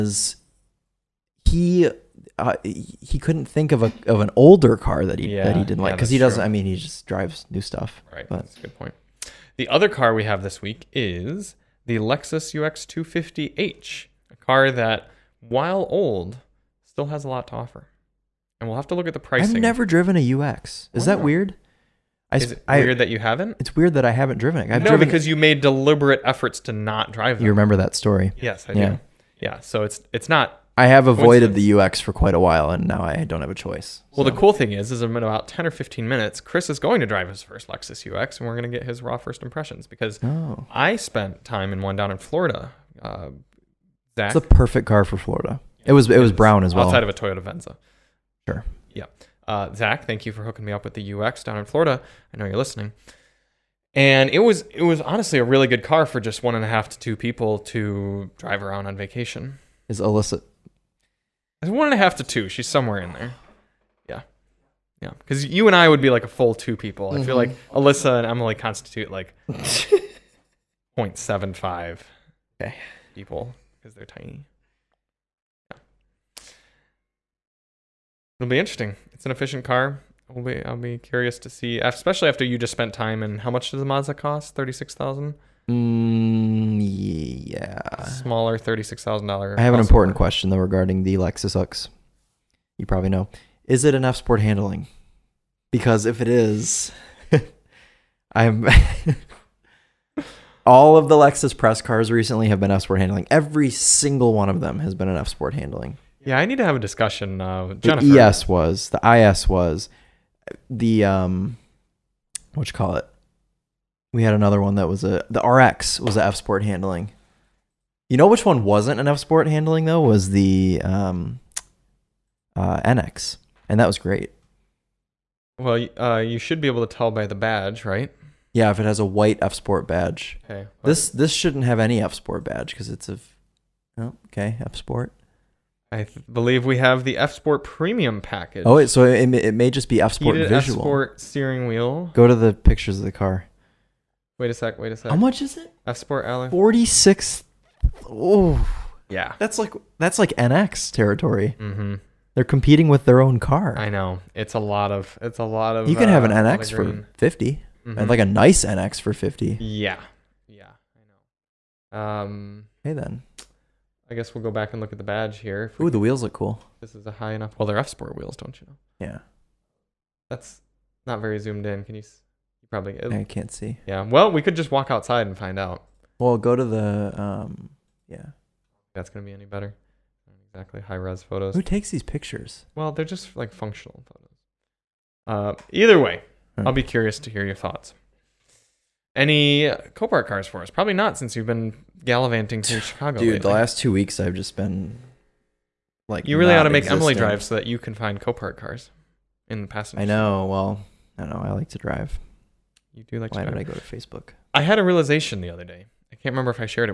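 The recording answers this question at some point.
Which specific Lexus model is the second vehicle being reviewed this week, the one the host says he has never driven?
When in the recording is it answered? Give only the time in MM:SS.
00:11.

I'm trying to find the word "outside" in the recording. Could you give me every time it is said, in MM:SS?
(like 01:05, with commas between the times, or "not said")
00:46, 02:54.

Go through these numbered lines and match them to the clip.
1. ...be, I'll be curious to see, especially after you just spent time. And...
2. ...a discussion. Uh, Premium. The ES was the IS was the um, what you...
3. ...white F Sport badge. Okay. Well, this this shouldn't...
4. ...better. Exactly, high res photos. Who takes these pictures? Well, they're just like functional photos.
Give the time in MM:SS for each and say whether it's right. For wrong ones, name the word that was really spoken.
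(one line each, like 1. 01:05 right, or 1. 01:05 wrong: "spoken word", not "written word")
1. 01:20 right
2. 01:46 wrong: "Jennifer", not "Premium"
3. 02:09 right
4. 02:59 right.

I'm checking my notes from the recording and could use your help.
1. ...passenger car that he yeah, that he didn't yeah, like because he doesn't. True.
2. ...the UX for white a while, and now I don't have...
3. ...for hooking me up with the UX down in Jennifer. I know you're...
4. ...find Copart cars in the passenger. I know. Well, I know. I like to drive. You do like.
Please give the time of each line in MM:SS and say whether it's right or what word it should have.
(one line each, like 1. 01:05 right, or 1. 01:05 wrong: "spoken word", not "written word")
1. 00:04 wrong: "older", not "passenger"
2. 00:31 wrong: "quite", not "white"
3. 00:50 wrong: "Florida", not "Jennifer"
4. 03:17 right.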